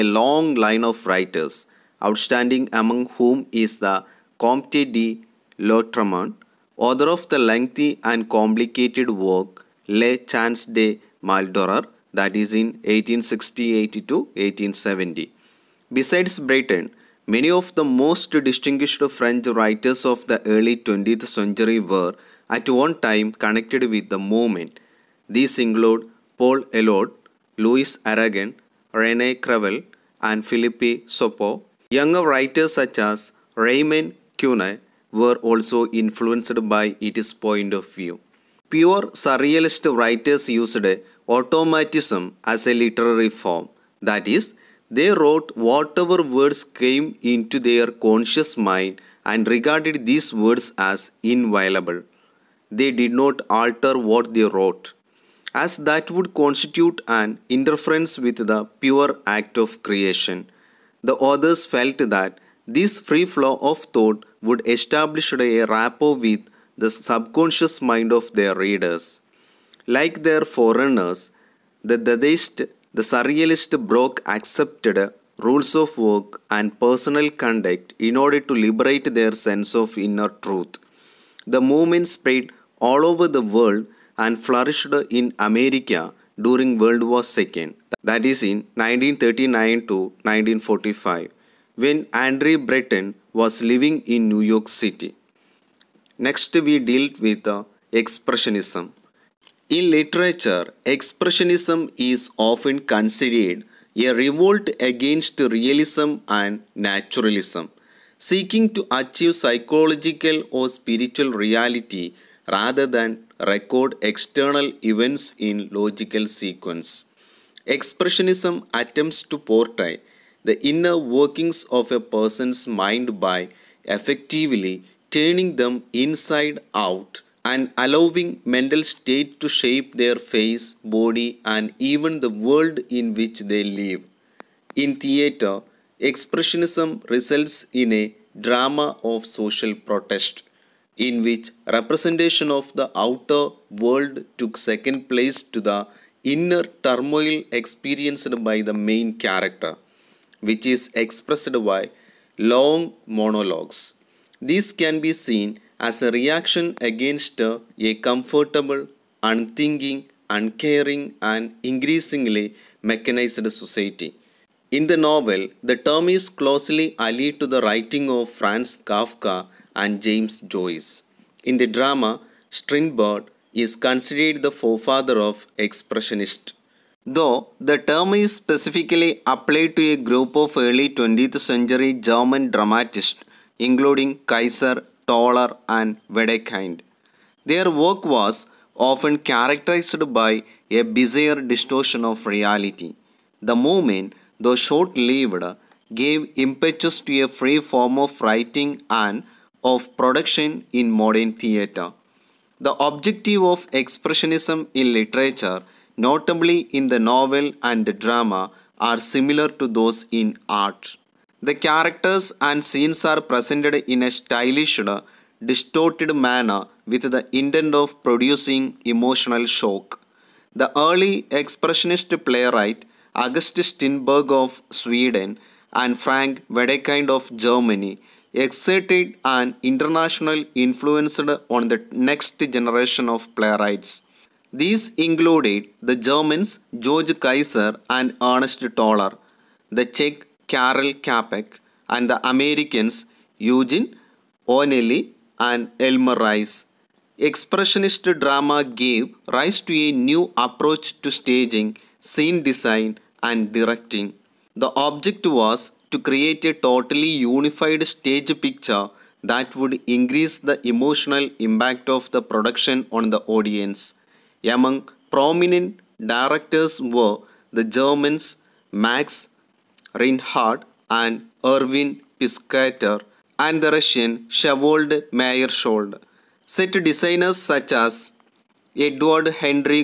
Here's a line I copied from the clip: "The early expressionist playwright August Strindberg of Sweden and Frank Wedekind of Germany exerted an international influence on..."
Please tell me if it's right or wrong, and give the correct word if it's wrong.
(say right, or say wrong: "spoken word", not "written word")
right.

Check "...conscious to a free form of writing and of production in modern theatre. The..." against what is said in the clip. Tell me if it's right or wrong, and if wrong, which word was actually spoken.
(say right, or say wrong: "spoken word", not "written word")
wrong: "impetus", not "conscious".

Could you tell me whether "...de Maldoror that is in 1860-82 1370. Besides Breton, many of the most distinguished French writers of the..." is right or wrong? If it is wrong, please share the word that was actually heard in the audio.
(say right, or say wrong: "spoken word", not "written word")
wrong: "1870", not "1370".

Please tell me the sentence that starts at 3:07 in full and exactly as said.
Their work was often characterized by a bizarre distortion of reality.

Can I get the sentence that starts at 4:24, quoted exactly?
Among prominent directors were the Germans Max Reinhardt and Erwin Piscator and the Russian Vsevolod Meyerhold.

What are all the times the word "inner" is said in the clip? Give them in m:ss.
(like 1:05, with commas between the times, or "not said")
1:19, 2:00, 2:26.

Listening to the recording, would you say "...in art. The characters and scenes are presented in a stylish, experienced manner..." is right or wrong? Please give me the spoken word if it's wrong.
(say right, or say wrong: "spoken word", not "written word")
wrong: "distorted", not "experienced".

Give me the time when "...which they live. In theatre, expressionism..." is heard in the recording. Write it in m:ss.
2:13.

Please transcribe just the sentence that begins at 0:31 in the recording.
Younger writers such as Raymond Queneau were also influenced by its point of view.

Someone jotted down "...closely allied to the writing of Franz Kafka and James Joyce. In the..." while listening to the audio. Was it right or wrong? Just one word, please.
right.